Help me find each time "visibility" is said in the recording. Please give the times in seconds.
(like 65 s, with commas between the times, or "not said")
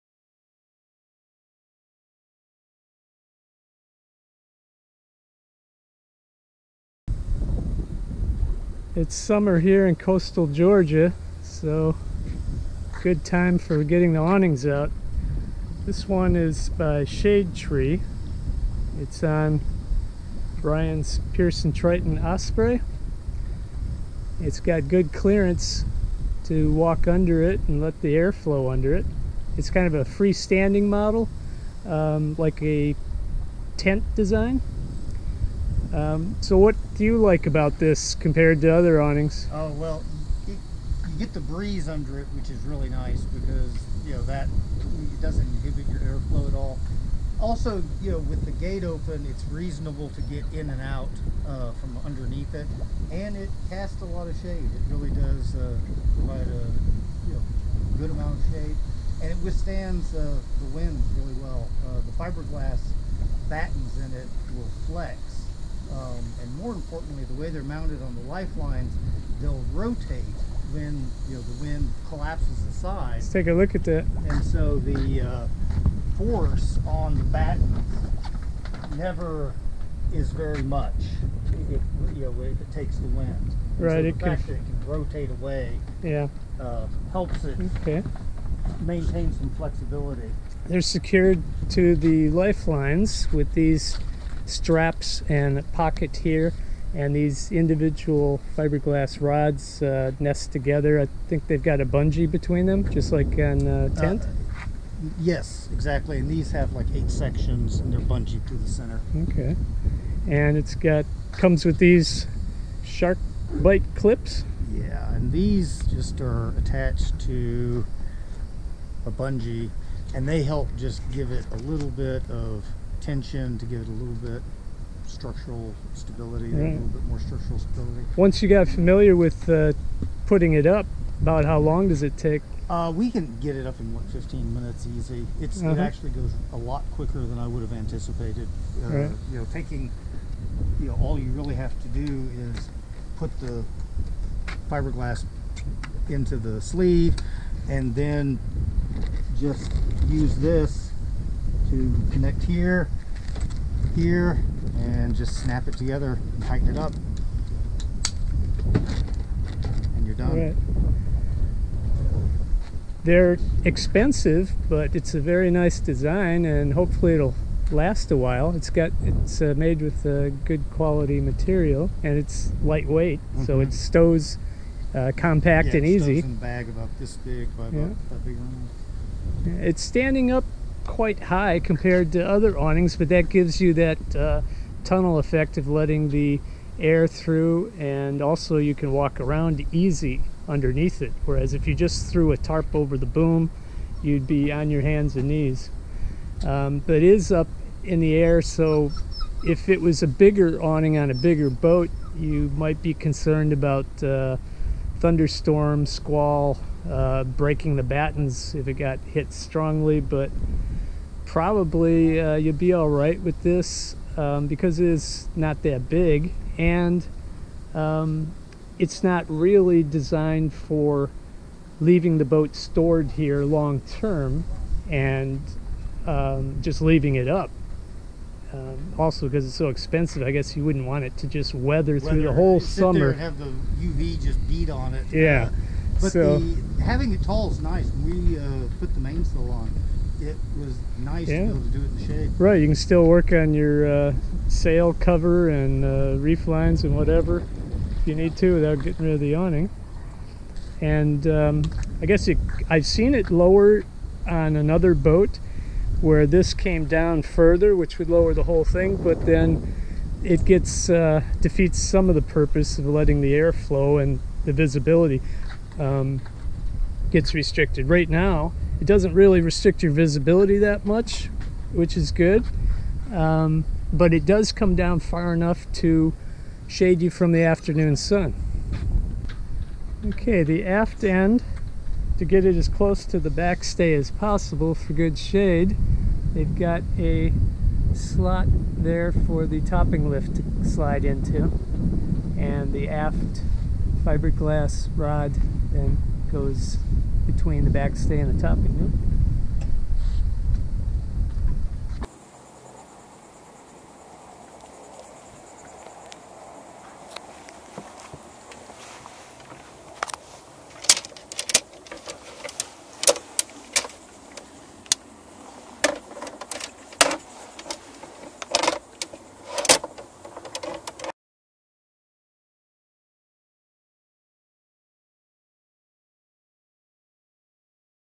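264 s, 269 s.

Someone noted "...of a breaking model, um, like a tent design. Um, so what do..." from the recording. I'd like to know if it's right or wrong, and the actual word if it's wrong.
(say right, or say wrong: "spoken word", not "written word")
wrong: "freestanding", not "breaking".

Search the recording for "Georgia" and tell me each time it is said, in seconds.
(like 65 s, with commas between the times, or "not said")
10 s.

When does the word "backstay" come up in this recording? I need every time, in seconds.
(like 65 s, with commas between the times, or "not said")
283 s, 297 s.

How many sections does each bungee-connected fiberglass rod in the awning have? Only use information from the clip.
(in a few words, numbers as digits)
8.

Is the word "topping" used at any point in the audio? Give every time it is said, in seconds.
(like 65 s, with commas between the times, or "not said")
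289 s, 298 s.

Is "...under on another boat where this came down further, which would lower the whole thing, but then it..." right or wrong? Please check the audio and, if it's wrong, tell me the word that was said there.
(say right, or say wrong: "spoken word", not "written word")
wrong: "lower", not "under".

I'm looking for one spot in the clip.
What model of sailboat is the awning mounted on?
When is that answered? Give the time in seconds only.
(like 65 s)
21 s.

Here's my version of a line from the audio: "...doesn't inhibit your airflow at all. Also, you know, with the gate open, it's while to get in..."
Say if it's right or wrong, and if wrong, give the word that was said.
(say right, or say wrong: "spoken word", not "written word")
wrong: "reasonable", not "while".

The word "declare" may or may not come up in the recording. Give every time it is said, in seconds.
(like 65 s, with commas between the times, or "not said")
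not said.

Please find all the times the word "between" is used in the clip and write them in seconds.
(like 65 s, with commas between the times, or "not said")
102 s, 297 s.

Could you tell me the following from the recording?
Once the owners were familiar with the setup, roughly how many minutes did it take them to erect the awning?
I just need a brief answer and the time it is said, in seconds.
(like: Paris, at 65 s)
15, at 134 s.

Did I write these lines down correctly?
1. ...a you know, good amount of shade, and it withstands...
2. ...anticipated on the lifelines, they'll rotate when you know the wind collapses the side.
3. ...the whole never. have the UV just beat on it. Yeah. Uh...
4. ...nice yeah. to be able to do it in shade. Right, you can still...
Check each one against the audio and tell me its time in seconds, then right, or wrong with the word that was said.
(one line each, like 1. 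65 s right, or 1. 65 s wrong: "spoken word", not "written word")
1. 56 s right
2. 67 s wrong: "mounted", not "anticipated"
3. 232 s wrong: "summer", not "never"
4. 240 s right.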